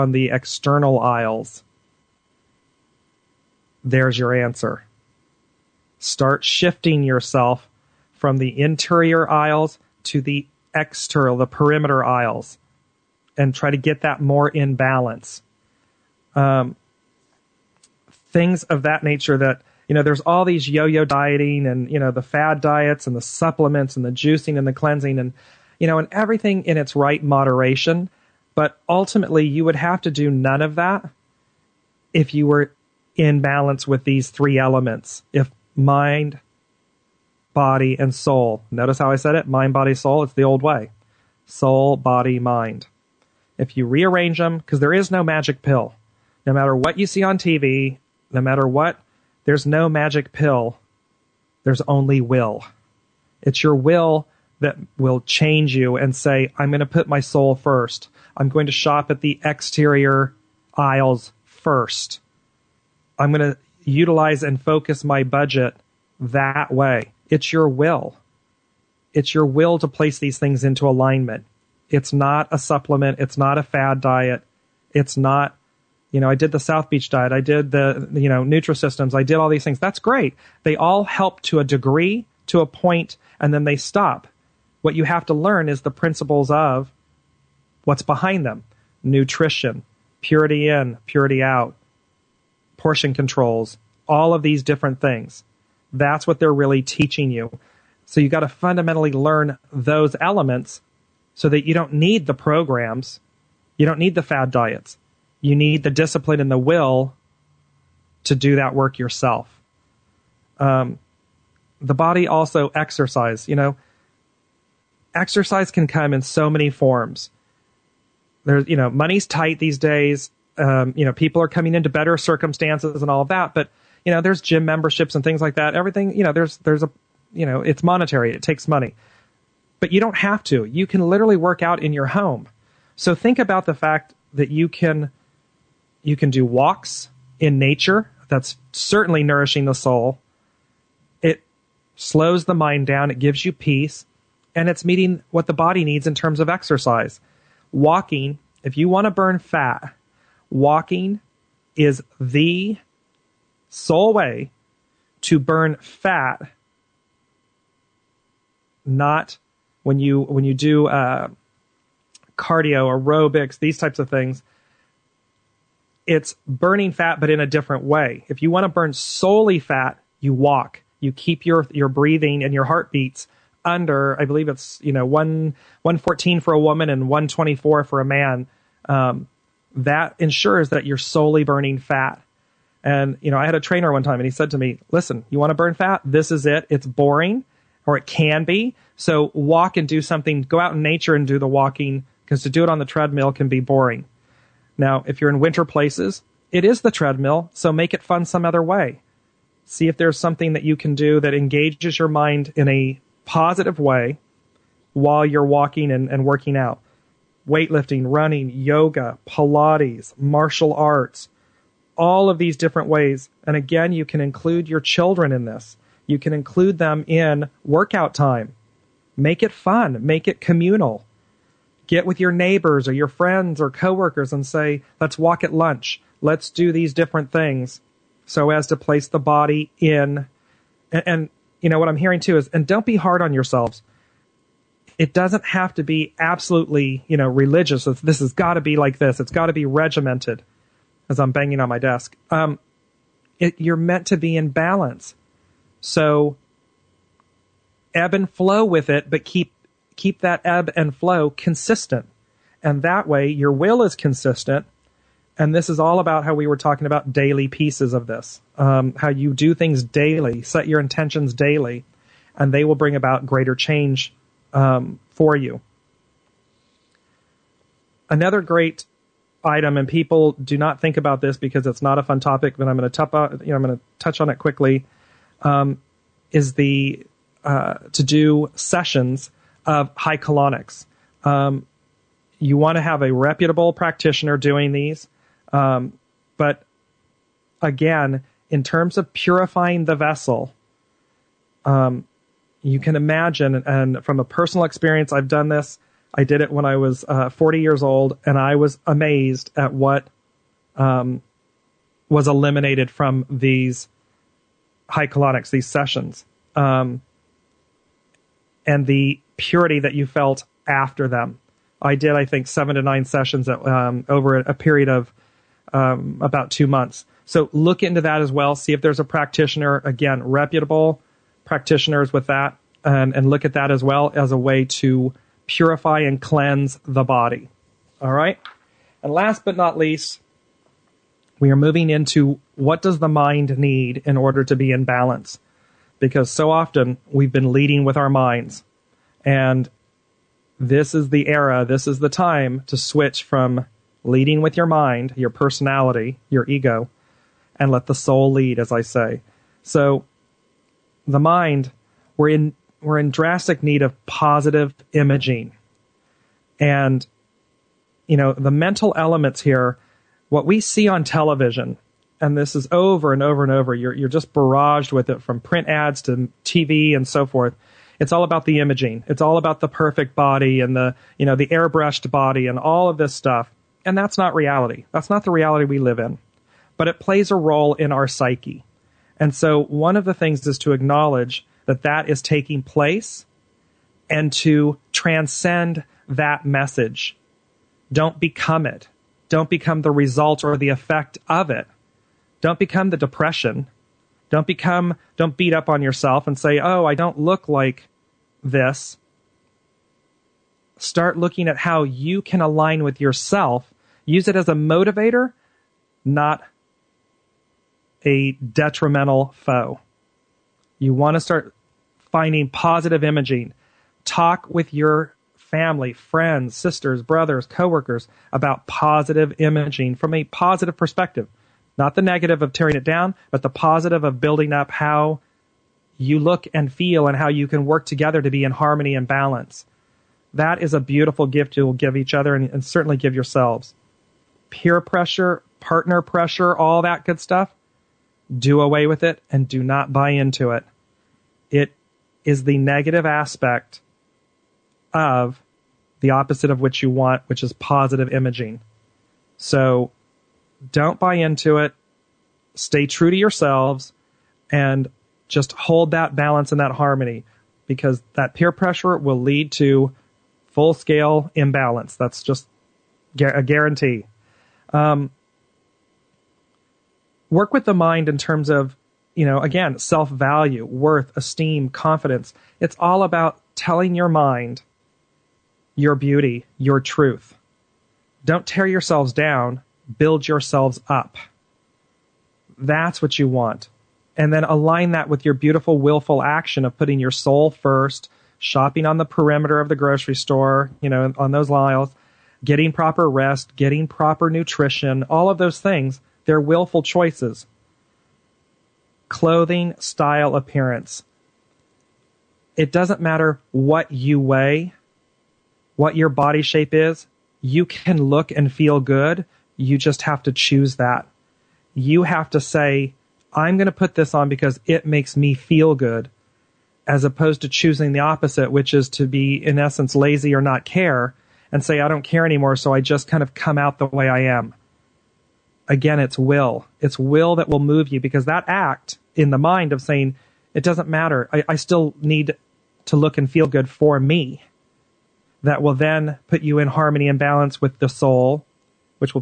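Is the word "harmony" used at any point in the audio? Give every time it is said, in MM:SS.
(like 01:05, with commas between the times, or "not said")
07:08, 07:36, 08:56.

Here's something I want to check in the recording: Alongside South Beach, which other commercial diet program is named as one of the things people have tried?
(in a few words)
Nutrisystems.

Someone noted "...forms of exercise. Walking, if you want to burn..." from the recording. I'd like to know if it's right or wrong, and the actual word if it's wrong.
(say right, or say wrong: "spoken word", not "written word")
wrong: "terms", not "forms".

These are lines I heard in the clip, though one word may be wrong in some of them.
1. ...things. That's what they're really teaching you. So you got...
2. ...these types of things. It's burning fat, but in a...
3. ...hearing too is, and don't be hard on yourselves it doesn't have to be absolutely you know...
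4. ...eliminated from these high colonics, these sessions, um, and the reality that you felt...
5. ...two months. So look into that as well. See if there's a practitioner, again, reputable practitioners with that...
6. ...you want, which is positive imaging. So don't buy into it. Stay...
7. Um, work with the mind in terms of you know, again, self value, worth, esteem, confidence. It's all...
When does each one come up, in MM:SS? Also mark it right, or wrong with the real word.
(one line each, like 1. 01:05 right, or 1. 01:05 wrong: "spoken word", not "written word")
1. 01:35 right
2. 02:43 right
3. 03:51 right
4. 05:02 wrong: "purity", not "reality"
5. 05:16 right
6. 07:26 right
7. 07:44 right.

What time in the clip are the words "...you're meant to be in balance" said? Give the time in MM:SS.
04:03.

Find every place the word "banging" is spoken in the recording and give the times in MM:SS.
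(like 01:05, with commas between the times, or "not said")
04:01.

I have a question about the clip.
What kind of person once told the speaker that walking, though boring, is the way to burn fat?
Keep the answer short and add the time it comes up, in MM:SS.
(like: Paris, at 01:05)
A trainer, at 03:03.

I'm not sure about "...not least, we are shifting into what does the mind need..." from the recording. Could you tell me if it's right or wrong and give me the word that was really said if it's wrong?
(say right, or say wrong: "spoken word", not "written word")
wrong: "moving", not "shifting".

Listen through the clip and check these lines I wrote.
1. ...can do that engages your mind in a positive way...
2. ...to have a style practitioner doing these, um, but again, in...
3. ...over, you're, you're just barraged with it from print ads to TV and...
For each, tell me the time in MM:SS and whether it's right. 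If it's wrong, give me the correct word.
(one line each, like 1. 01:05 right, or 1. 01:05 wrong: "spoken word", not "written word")
1. 03:20 right
2. 04:42 wrong: "reputable", not "style"
3. 06:03 right.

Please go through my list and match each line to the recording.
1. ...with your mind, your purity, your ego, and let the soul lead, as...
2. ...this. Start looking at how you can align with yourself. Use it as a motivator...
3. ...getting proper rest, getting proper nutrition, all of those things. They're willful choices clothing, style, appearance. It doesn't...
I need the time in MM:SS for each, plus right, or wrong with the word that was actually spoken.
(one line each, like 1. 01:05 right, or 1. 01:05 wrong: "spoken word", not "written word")
1. 05:44 wrong: "personality", not "purity"
2. 06:38 right
3. 08:12 right.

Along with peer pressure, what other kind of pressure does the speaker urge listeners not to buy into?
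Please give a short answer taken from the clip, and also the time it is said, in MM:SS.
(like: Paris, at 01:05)
Partner pressure, at 07:15.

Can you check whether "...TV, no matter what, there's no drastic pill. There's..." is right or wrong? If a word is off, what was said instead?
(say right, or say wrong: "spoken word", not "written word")
wrong: "magic", not "drastic".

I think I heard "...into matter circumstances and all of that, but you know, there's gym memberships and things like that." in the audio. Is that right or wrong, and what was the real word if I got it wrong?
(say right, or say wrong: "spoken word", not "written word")
wrong: "better", not "matter".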